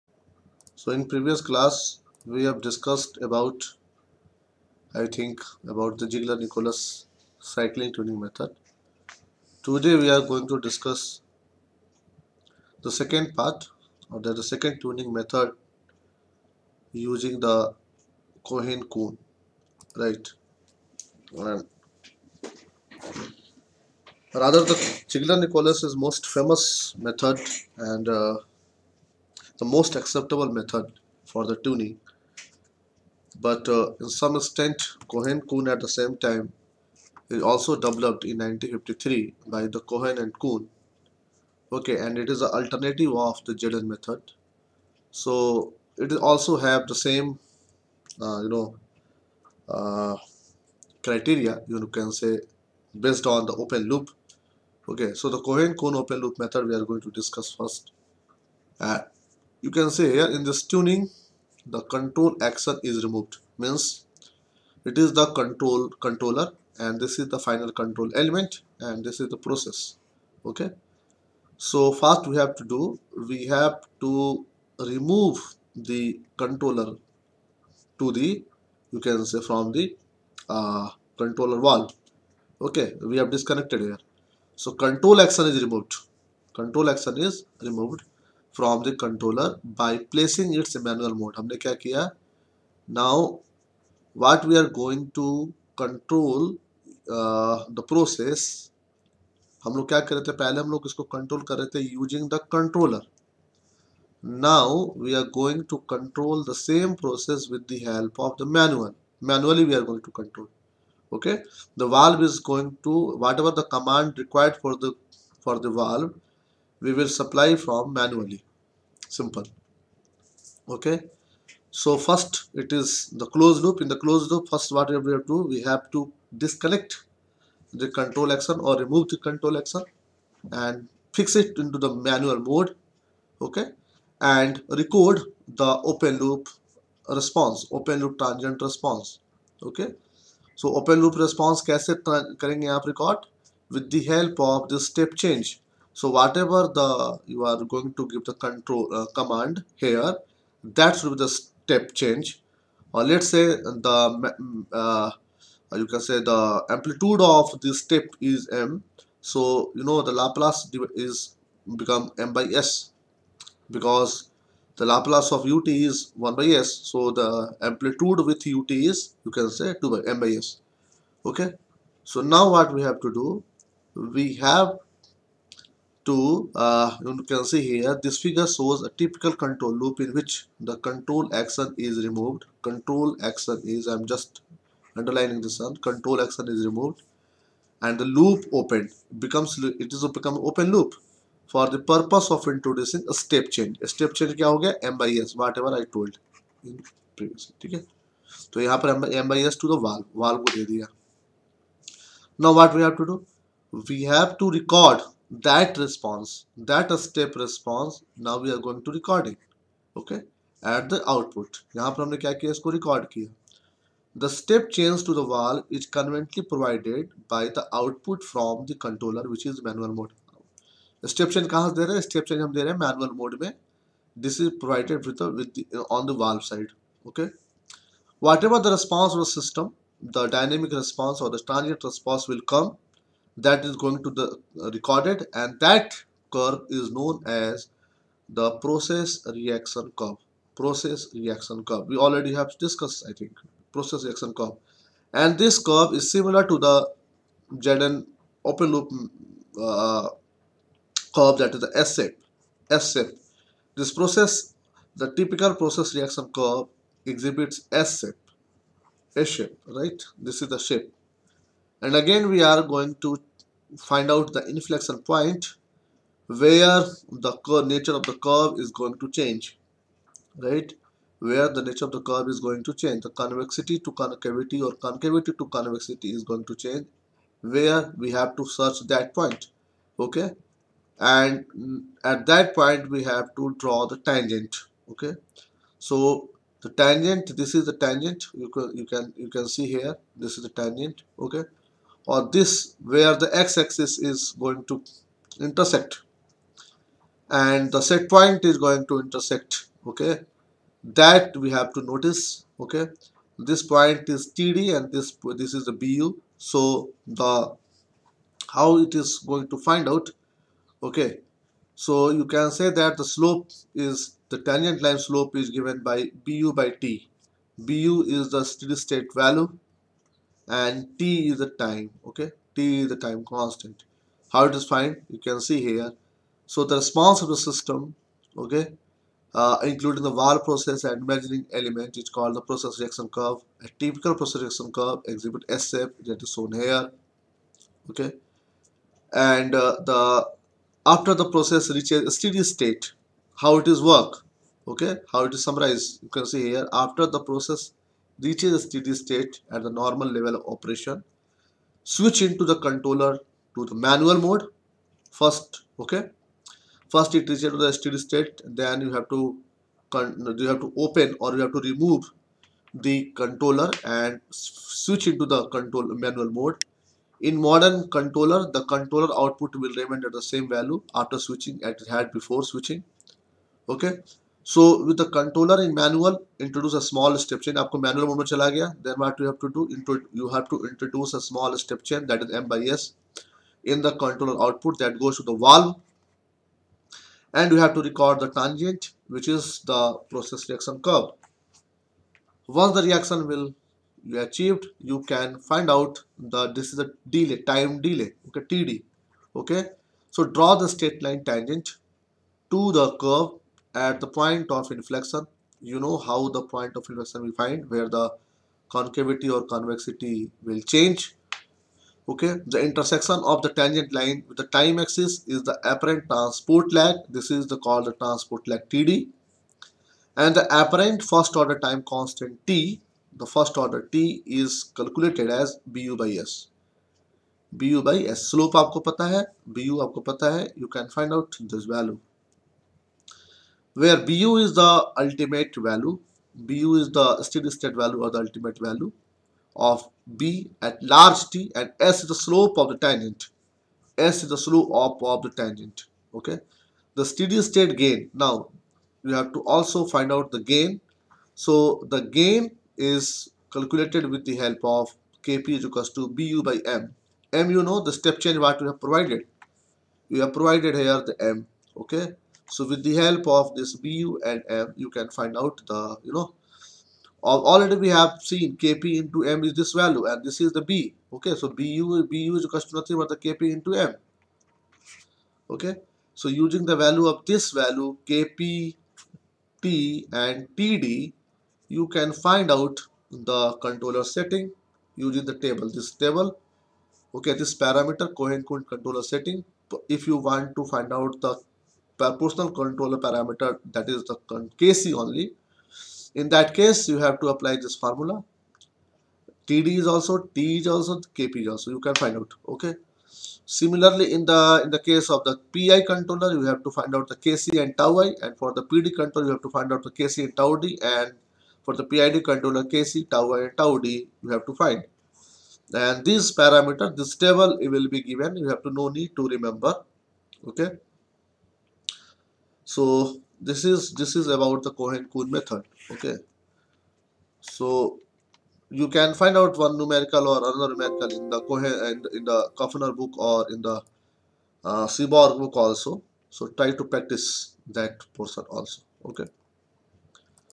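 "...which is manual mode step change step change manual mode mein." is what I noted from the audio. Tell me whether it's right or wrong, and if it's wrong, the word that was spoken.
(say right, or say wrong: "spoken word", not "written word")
right.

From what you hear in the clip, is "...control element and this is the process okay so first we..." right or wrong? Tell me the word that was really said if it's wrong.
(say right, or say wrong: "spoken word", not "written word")
right.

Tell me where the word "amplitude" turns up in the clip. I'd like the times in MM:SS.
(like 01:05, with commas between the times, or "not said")
02:36, 02:47.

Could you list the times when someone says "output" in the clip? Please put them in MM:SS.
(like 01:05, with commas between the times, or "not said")
03:31, 03:37, 06:09, 06:24.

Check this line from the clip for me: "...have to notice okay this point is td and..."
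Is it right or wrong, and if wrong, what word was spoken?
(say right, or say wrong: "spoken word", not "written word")
right.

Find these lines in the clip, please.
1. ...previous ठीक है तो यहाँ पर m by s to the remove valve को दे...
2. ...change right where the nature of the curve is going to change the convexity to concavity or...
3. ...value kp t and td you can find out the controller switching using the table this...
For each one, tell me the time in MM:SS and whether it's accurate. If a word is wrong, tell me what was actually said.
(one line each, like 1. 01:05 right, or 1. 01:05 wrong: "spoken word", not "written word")
1. 03:17 wrong: "valve", not "remove"
2. 04:29 right
3. 07:57 wrong: "setting", not "switching".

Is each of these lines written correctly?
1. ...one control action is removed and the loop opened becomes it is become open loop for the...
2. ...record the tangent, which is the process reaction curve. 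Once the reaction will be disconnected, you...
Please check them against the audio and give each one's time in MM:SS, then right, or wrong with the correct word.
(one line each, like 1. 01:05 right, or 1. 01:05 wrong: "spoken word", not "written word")
1. 03:05 right
2. 06:27 wrong: "achieved", not "disconnected".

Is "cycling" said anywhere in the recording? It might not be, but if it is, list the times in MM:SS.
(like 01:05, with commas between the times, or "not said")
00:07.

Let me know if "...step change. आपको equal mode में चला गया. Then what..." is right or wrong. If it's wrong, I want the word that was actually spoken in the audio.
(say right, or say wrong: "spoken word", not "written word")
wrong: "manual", not "equal".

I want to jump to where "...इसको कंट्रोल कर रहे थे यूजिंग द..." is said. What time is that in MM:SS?
01:40.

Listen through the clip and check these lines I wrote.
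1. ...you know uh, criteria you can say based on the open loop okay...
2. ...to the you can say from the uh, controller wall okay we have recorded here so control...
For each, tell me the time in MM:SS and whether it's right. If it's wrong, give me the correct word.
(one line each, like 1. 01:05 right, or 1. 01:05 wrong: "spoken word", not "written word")
1. 00:48 right
2. 01:17 wrong: "disconnected", not "recorded".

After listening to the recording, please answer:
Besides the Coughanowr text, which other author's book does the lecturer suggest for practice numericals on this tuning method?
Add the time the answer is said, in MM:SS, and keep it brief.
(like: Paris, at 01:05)
Seborg, at 08:54.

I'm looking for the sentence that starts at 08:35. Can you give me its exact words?
And this parameter, this table, it will be given.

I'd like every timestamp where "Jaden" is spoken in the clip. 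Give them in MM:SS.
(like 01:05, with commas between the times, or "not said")
00:43, 04:07.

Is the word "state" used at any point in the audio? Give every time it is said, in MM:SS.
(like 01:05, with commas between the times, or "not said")
05:18, 05:42, 05:48, 05:57, 07:17, 07:27.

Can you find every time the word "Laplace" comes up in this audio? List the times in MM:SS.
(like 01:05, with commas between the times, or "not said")
02:40, 02:44.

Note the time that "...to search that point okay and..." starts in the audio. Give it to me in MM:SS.
04:38.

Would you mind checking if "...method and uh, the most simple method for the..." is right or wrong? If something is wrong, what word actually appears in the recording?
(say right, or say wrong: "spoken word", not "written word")
wrong: "acceptable", not "simple".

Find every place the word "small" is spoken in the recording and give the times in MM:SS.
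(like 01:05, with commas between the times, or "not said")
06:16, 06:21.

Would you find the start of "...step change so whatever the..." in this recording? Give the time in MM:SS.
02:24.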